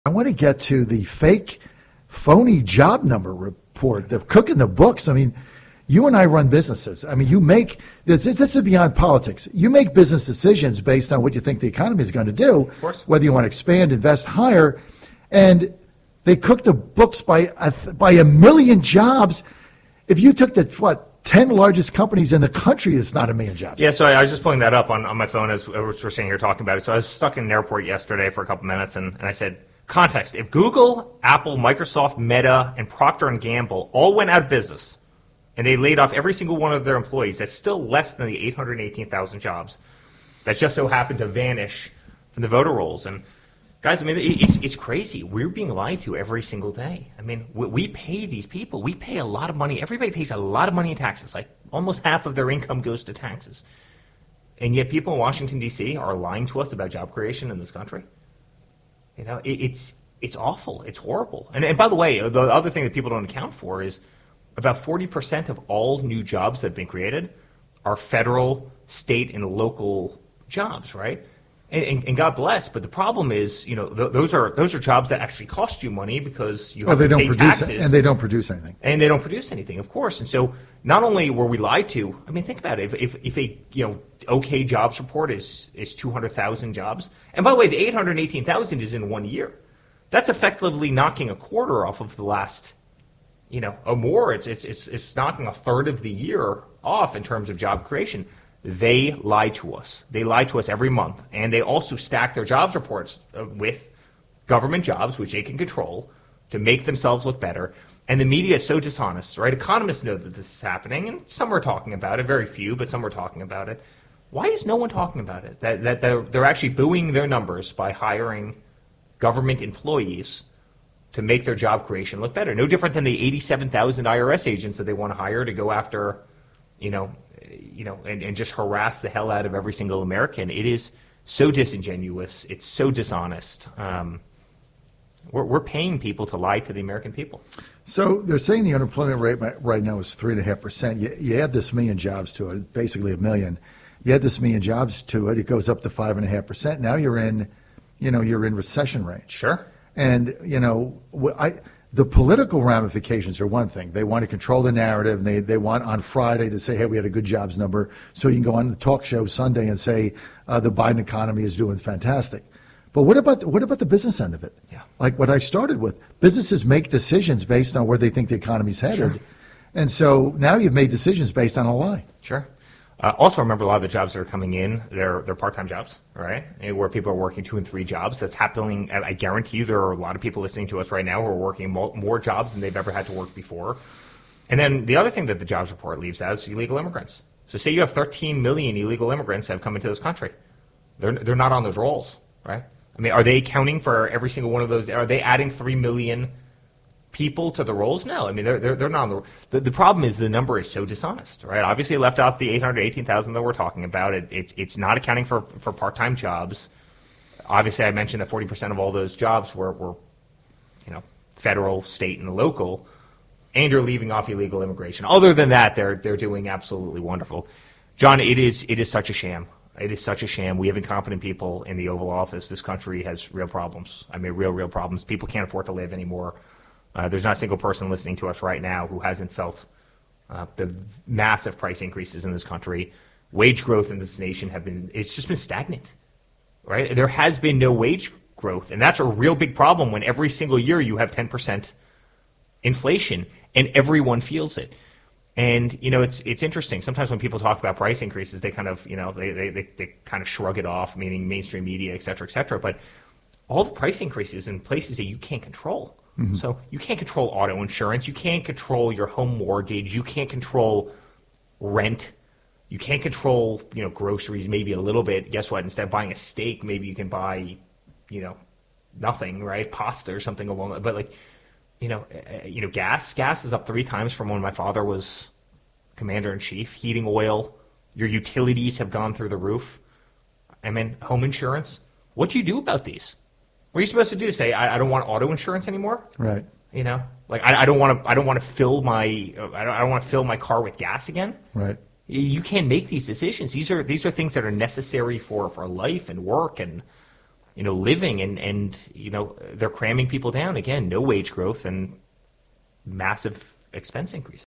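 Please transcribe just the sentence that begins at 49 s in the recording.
Everybody pays a lot of money in taxes.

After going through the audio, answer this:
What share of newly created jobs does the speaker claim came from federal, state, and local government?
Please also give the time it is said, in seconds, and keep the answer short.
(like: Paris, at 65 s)
40%, at 64 s.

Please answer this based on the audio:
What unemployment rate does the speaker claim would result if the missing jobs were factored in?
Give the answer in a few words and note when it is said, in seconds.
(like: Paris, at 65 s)
5.5%, at 145 s.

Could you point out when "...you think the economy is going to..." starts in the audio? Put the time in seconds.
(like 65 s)
11 s.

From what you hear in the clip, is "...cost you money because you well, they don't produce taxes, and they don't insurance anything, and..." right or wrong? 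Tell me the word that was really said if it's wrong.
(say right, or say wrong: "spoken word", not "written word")
wrong: "produce", not "insurance".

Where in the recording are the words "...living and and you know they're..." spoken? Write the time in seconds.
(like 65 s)
297 s.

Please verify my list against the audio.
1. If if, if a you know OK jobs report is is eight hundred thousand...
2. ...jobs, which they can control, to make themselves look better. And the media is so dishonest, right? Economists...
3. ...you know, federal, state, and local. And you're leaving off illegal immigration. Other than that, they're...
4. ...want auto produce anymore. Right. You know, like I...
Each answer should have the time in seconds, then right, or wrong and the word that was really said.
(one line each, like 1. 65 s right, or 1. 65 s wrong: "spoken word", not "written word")
1. 82 s wrong: "two", not "eight"
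2. 104 s right
3. 210 s right
4. 284 s wrong: "insurance", not "produce".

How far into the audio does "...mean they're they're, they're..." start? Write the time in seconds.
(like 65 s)
198 s.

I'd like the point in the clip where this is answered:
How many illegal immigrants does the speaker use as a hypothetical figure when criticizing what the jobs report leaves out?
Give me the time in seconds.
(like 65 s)
187 s.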